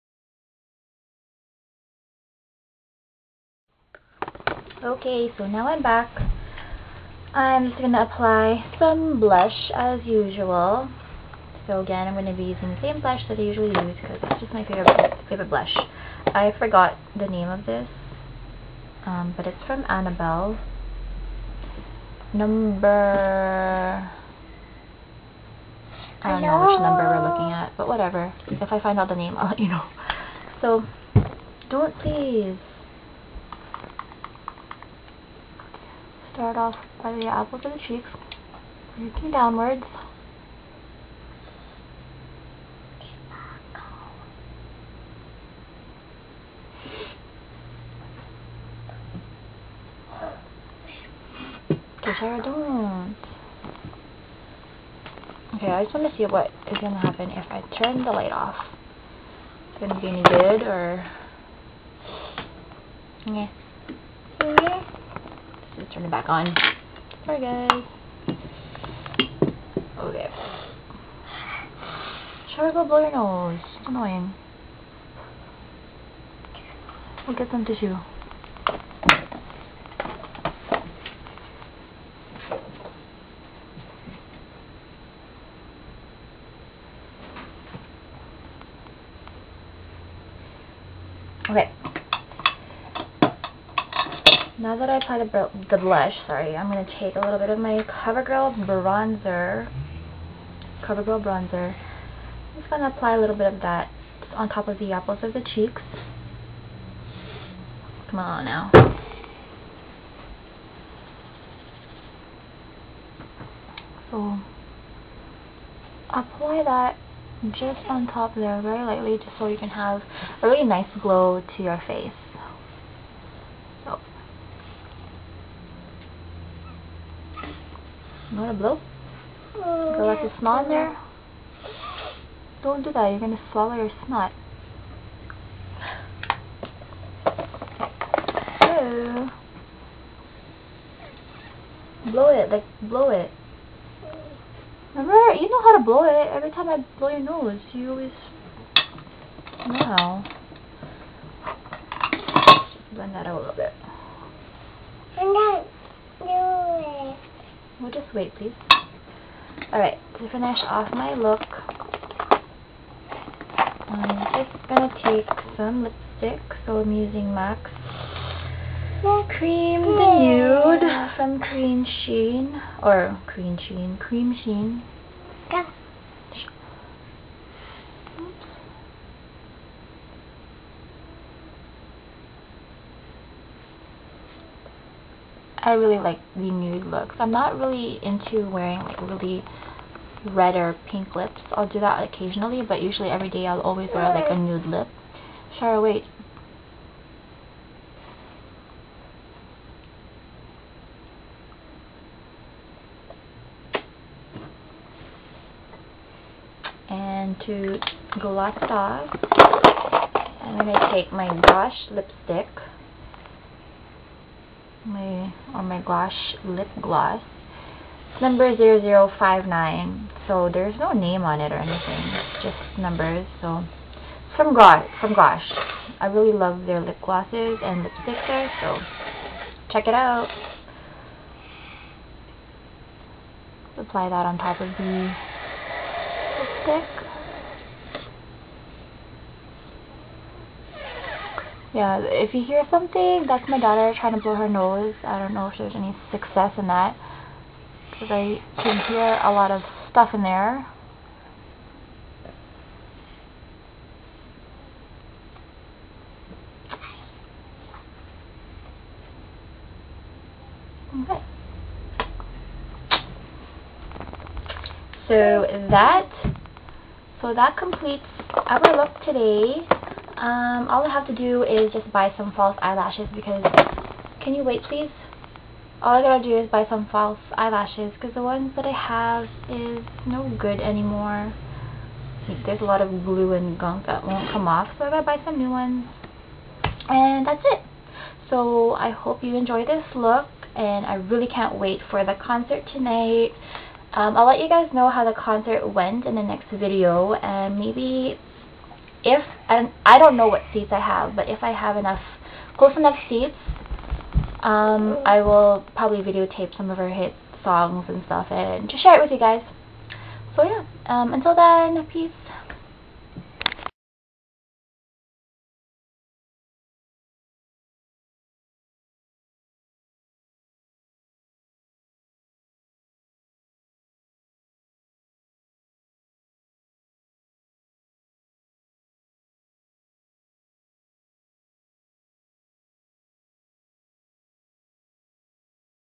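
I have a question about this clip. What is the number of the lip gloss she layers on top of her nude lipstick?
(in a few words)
0059.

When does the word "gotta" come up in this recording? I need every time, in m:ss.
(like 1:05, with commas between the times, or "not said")
4:36, 4:44.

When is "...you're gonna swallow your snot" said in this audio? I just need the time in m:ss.
2:13.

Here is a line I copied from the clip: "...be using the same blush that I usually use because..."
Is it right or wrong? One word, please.
right.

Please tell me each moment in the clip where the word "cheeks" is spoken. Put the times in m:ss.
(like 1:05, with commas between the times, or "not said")
0:37, 1:45.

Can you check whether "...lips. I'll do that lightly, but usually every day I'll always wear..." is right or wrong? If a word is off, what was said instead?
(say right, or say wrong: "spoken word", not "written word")
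wrong: "occasionally", not "lightly".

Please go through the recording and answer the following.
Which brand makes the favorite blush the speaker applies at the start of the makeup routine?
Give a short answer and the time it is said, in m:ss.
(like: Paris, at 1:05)
Annabelle, at 0:19.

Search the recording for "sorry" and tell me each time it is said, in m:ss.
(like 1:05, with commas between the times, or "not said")
1:07, 1:36.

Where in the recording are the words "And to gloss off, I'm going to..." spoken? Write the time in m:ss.
3:26.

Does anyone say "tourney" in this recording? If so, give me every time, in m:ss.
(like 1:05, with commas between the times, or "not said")
not said.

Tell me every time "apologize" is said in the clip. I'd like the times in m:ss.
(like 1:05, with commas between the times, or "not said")
not said.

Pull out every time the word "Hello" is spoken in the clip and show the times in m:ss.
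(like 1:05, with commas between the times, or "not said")
0:26.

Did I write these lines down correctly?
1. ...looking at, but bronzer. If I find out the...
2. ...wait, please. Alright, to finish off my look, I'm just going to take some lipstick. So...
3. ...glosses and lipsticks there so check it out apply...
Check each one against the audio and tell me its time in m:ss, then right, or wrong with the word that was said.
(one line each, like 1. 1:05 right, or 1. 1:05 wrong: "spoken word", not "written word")
1. 0:27 wrong: "whatever", not "bronzer"
2. 2:38 right
3. 3:47 right.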